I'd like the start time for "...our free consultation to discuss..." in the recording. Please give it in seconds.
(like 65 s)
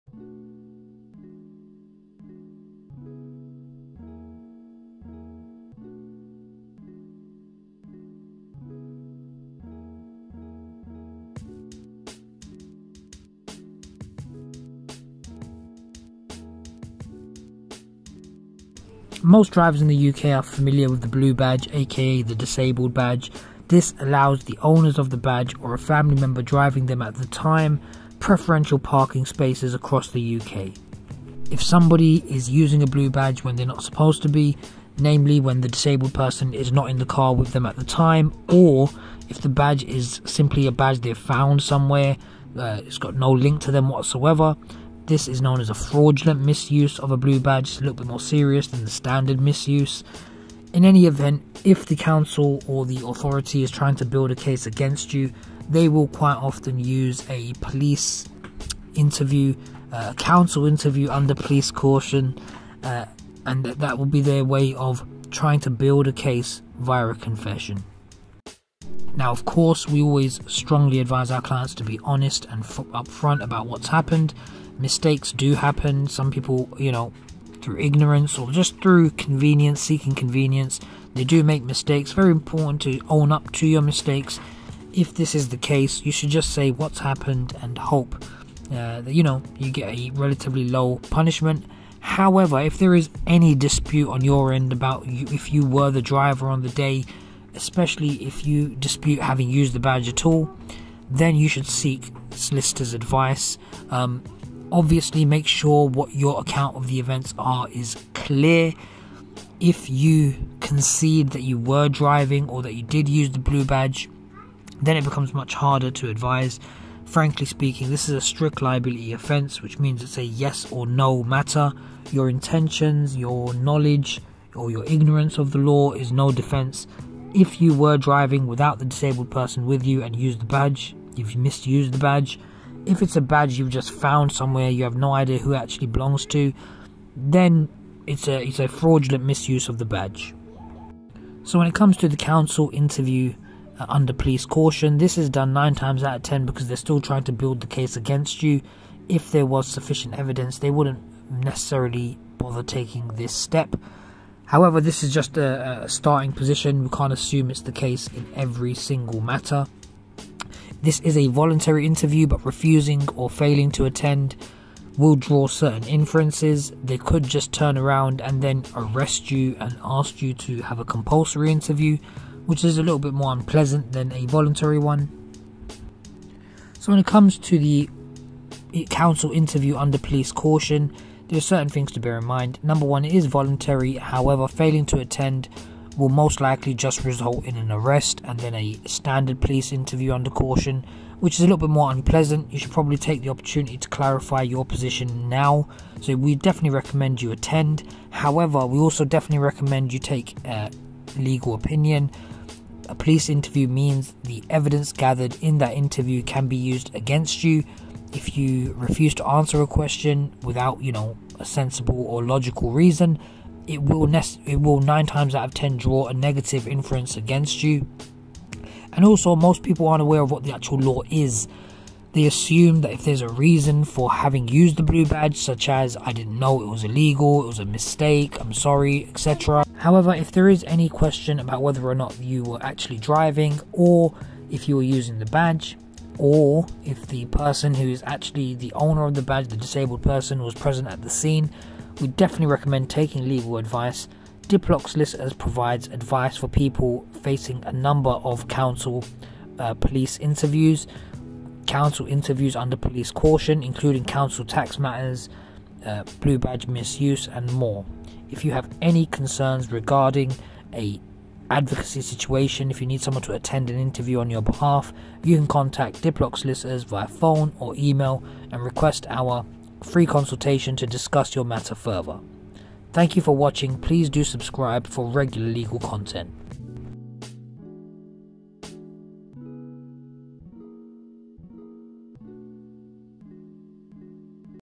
269 s.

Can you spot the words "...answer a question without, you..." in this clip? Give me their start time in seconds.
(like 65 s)
209 s.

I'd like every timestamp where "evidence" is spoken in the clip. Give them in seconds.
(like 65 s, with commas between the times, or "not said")
150 s, 204 s.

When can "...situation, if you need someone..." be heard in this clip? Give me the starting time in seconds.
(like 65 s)
262 s.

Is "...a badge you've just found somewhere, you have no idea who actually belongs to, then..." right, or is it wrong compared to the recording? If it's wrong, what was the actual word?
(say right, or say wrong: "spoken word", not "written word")
right.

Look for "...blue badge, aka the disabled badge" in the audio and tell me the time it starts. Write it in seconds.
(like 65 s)
21 s.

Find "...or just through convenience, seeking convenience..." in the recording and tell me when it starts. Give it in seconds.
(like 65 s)
78 s.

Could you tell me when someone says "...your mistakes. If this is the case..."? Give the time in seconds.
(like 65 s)
83 s.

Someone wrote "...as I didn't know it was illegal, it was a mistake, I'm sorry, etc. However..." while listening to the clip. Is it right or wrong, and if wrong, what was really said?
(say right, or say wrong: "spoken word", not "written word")
right.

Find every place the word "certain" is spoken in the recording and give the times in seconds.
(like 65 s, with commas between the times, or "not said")
165 s, 181 s.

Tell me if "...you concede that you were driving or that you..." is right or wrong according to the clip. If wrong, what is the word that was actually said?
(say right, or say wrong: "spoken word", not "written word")
right.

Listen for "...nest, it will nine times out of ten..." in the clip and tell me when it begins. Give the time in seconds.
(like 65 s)
214 s.